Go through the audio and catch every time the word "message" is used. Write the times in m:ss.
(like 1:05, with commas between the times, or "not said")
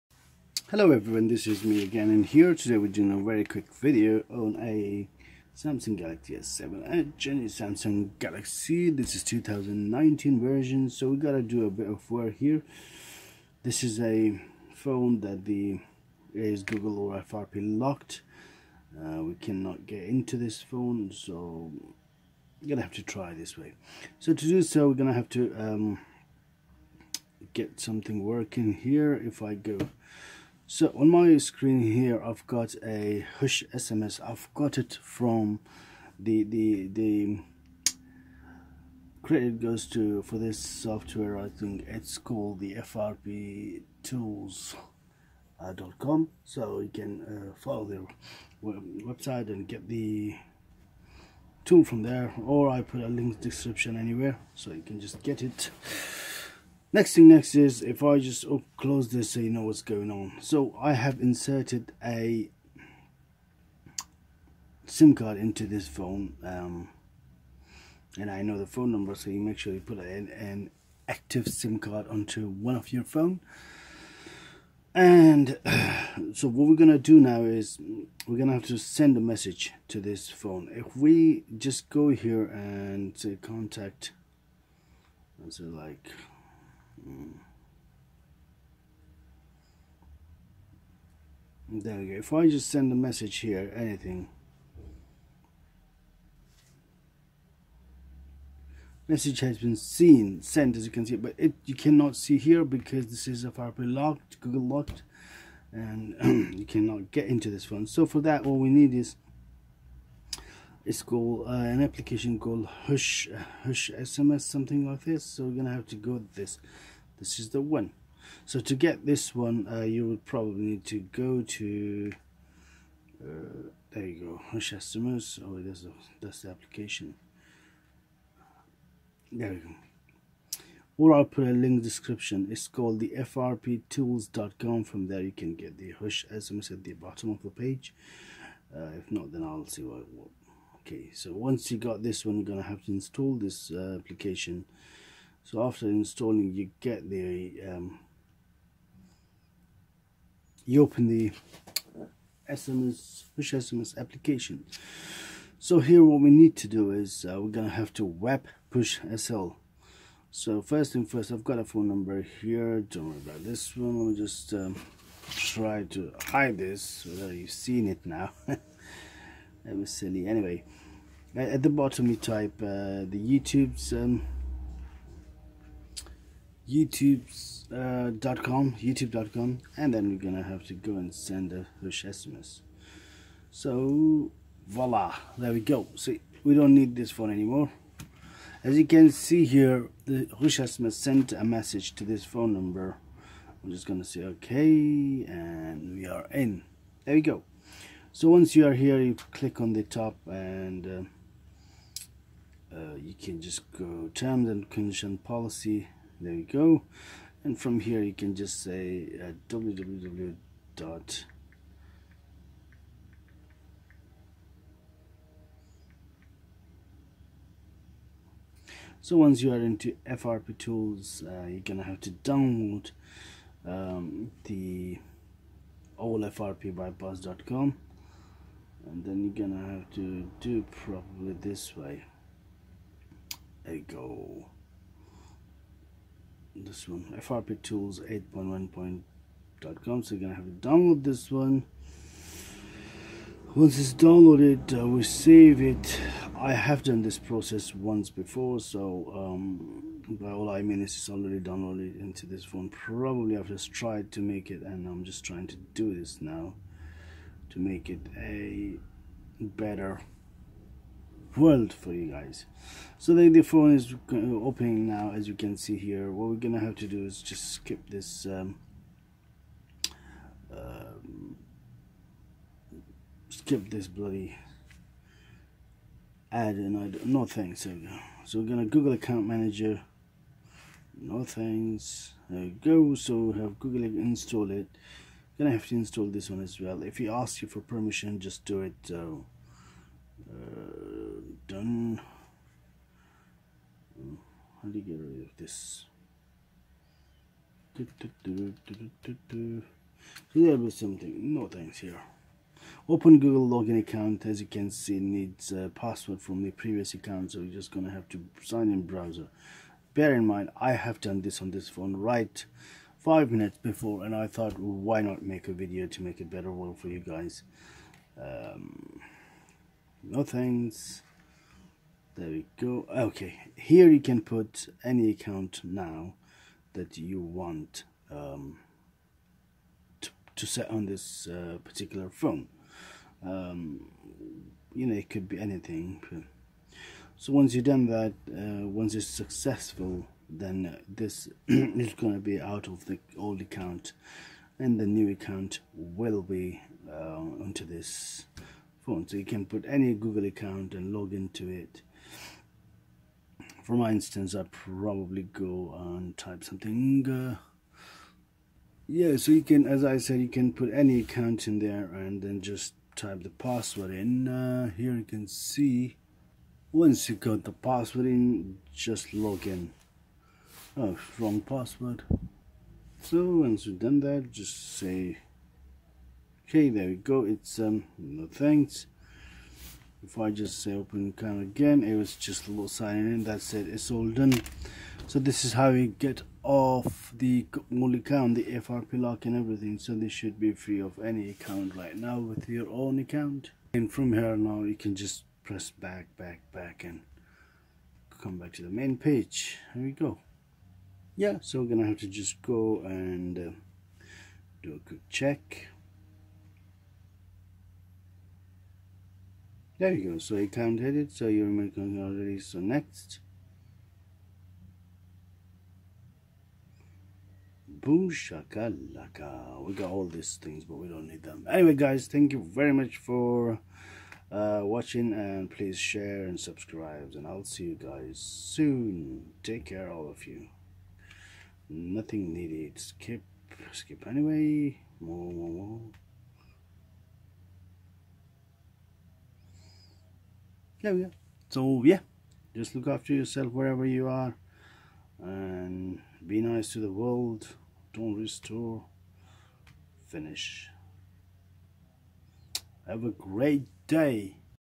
1:19, 1:32, 1:39, 3:11.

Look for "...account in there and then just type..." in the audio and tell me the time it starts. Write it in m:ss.
6:01.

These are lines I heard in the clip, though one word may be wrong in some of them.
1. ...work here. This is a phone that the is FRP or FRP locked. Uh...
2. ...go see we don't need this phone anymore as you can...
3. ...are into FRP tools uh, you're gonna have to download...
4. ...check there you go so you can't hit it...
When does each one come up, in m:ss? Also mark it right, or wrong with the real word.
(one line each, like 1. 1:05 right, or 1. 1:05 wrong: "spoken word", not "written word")
1. 0:12 wrong: "Google", not "FRP"
2. 3:05 right
3. 3:39 right
4. 6:45 right.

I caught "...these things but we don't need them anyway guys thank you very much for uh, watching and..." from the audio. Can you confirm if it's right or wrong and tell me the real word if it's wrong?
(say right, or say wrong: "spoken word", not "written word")
right.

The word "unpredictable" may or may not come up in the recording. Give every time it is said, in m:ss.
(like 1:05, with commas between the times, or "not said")
not said.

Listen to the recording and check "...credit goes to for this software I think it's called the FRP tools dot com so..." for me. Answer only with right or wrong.
right.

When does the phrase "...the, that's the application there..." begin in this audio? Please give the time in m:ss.
2:05.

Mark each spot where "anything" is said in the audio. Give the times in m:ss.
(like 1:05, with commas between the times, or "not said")
1:33, 5:35.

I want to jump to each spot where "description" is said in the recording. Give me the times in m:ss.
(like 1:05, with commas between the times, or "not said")
0:53, 2:11.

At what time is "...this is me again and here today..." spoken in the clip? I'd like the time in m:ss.
0:01.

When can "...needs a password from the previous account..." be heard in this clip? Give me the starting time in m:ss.
5:04.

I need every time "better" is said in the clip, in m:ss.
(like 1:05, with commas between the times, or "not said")
4:19, 5:16.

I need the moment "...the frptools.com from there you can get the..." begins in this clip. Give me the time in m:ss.
2:12.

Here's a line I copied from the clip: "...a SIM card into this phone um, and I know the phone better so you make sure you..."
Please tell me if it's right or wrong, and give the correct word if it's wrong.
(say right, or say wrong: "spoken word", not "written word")
wrong: "number", not "better".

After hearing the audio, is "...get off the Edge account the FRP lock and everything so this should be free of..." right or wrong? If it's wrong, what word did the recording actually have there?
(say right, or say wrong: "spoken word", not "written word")
wrong: "Mul", not "Edge".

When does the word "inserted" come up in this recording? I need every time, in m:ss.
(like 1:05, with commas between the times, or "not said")
1:01.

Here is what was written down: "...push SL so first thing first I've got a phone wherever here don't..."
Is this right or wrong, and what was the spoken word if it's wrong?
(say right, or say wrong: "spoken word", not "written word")
wrong: "number", not "wherever".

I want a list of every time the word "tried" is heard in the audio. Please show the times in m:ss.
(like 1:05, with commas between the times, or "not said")
4:13.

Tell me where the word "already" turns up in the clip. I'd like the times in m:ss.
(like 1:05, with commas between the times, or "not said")
4:11, 6:52.